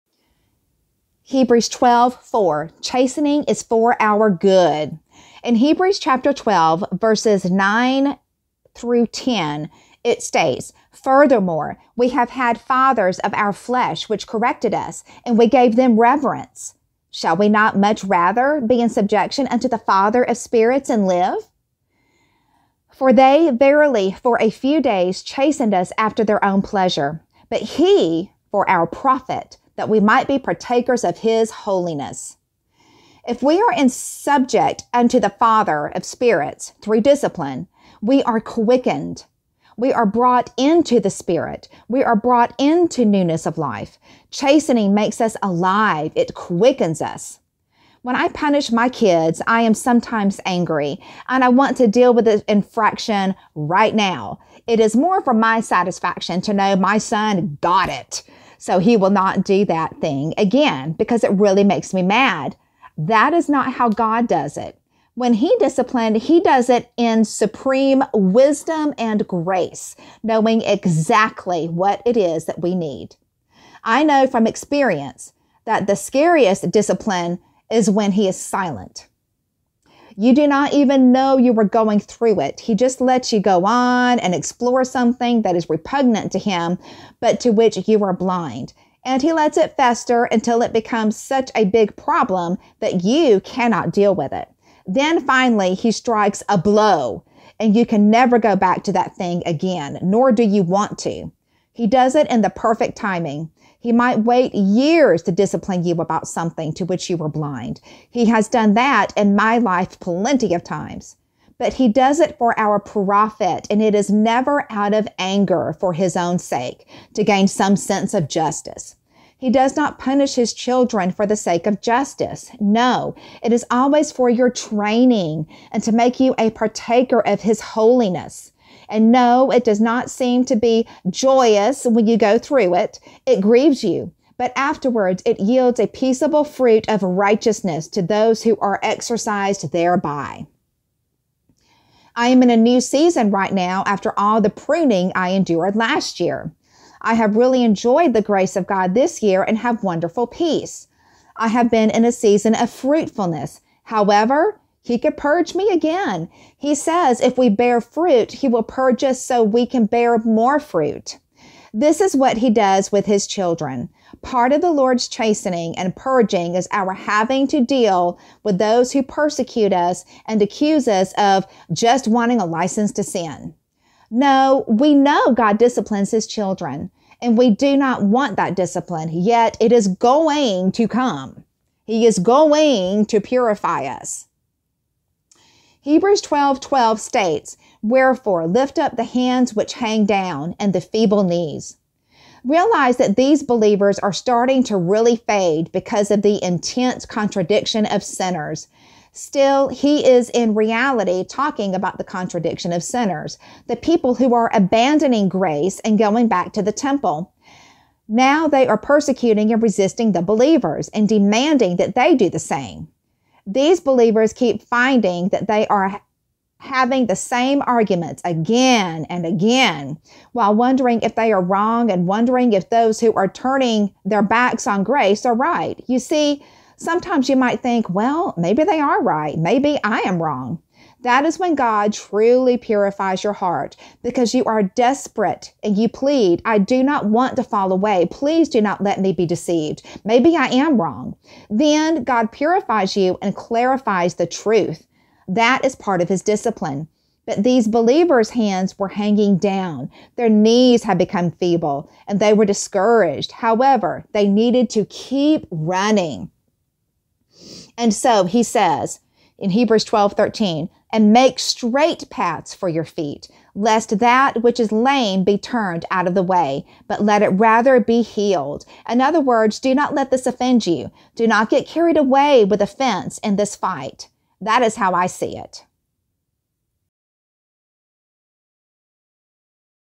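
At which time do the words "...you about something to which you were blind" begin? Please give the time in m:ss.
1:45.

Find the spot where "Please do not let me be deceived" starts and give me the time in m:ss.
3:58.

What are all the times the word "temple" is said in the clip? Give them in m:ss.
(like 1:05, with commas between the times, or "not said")
3:26.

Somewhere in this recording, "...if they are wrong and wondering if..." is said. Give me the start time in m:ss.
3:41.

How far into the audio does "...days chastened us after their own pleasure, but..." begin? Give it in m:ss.
0:24.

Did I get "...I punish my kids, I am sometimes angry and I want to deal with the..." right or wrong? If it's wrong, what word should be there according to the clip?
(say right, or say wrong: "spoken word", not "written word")
right.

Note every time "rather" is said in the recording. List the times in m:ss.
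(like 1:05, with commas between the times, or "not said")
0:18, 4:27.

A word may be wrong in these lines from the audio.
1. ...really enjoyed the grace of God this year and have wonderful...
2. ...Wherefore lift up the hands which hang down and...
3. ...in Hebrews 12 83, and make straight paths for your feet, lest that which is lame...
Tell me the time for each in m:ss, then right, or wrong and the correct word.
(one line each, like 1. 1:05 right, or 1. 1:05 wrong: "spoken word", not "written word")
1. 2:27 right
2. 3:07 right
3. 4:19 wrong: "13", not "83".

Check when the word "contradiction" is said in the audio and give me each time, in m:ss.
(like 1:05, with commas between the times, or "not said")
3:17, 3:22.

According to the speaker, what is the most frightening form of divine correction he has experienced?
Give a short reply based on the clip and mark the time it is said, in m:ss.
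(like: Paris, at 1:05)
When he is silent, at 1:17.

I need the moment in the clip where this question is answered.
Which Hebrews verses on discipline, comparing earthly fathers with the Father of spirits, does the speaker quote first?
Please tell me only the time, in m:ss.
0:06.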